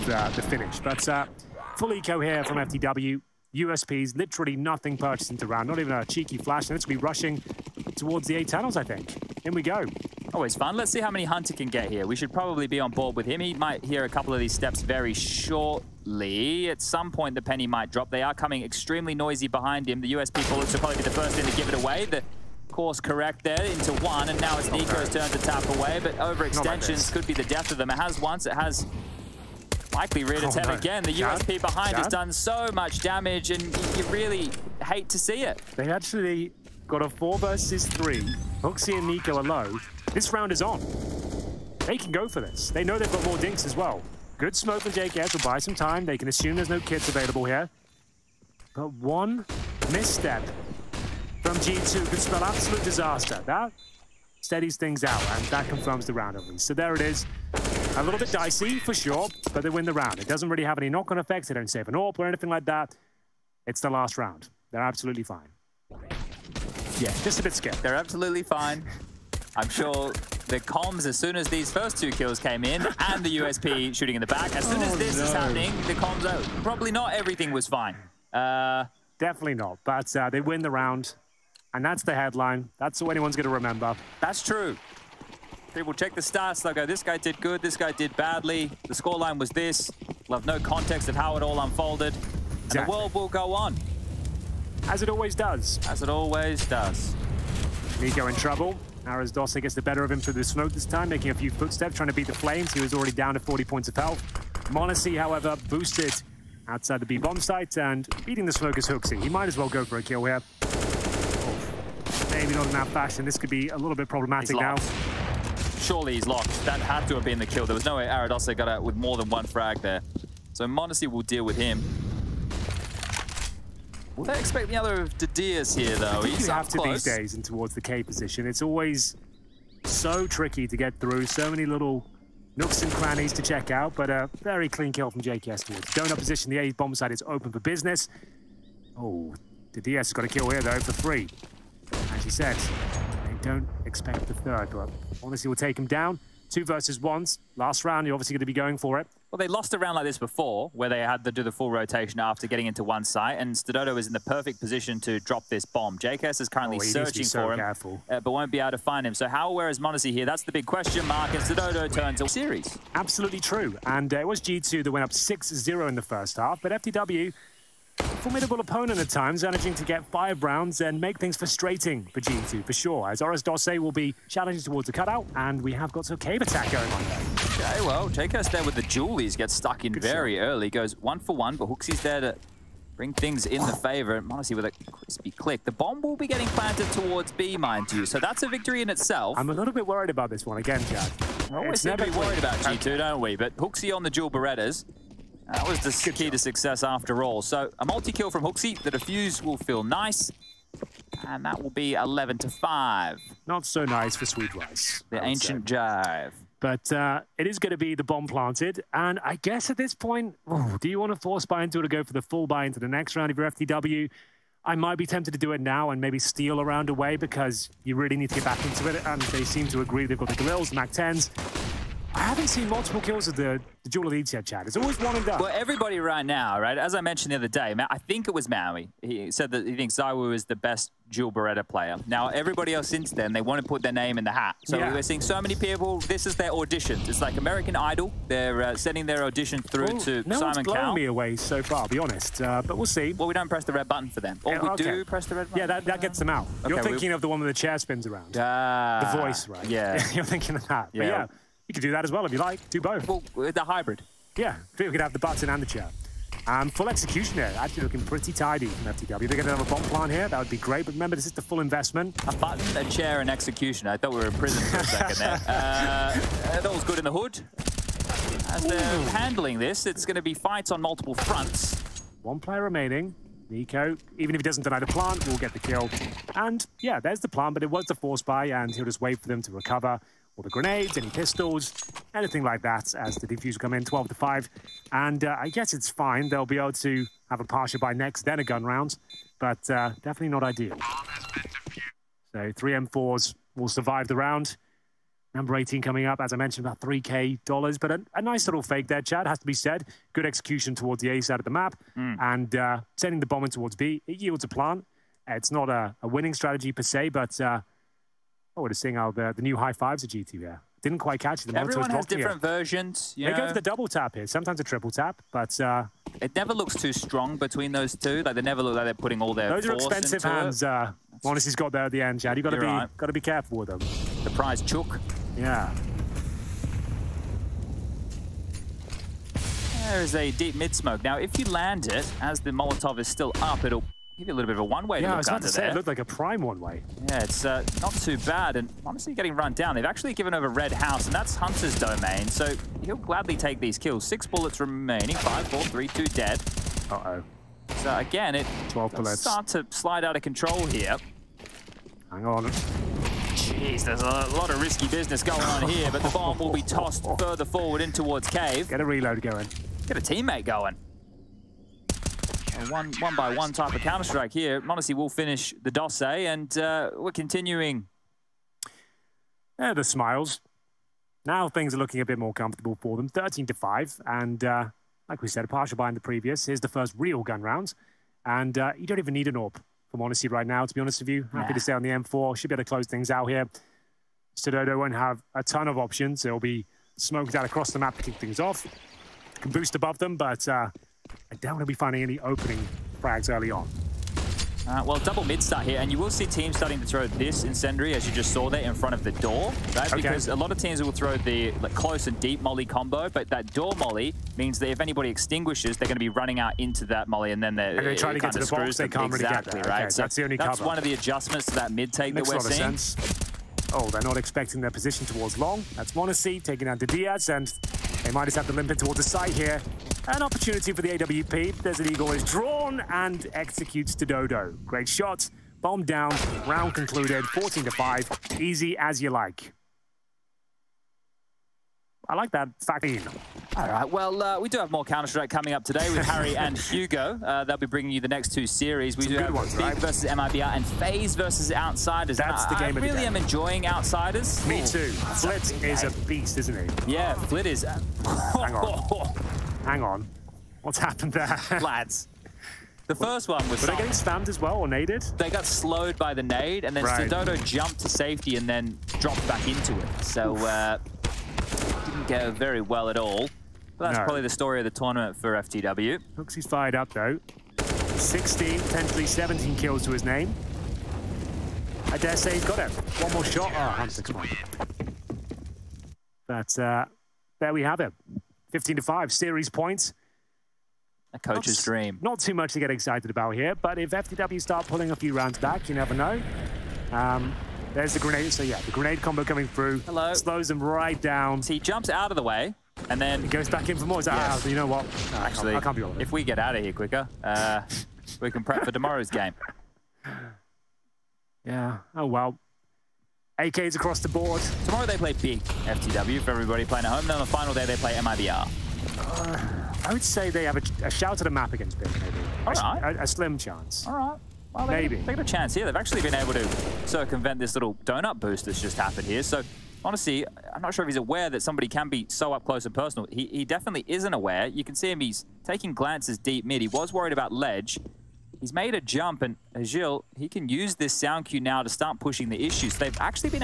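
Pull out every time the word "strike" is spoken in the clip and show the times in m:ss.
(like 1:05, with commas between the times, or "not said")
6:03, 7:14.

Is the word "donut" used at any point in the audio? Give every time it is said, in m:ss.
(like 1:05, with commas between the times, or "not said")
2:15, 8:37.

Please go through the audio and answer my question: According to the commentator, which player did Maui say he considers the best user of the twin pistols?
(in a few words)
Zaiwu.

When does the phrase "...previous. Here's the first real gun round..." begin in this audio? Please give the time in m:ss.
6:16.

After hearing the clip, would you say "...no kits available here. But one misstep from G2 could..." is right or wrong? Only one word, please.
right.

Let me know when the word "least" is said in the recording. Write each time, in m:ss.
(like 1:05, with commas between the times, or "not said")
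0:56.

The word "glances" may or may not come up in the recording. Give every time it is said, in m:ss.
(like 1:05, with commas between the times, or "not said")
8:45.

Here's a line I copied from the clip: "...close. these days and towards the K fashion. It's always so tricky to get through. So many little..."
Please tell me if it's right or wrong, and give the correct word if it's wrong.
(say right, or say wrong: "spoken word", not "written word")
wrong: "position", not "fashion".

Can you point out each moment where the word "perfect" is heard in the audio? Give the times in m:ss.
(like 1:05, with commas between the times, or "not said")
2:34.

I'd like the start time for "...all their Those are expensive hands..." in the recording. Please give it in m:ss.
5:19.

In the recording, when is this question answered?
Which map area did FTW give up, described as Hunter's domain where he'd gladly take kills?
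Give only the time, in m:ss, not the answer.
5:40.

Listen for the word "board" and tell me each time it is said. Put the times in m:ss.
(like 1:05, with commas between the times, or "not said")
0:12, 8:24.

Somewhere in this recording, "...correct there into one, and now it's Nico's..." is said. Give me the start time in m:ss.
0:22.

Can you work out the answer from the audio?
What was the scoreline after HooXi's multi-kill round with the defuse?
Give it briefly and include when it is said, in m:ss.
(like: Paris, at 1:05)
11 to 5, at 3:21.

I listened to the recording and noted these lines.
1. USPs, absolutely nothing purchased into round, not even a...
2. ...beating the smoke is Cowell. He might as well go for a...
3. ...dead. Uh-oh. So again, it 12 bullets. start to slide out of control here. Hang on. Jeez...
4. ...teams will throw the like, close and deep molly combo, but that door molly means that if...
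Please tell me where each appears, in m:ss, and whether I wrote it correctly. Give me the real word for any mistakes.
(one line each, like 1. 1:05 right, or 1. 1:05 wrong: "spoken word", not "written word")
1. 0:03 wrong: "literally", not "absolutely"
2. 1:48 wrong: "HooXi", not "Cowell"
3. 5:46 right
4. 6:40 right.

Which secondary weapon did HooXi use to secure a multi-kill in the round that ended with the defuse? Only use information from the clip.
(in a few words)
dual Berettas.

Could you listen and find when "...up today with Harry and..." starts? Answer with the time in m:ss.
7:15.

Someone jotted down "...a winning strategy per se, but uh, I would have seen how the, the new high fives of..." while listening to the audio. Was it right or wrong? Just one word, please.
right.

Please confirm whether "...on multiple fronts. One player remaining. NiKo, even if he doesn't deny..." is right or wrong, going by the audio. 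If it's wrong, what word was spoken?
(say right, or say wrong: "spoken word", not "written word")
right.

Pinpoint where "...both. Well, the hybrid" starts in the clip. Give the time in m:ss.
4:12.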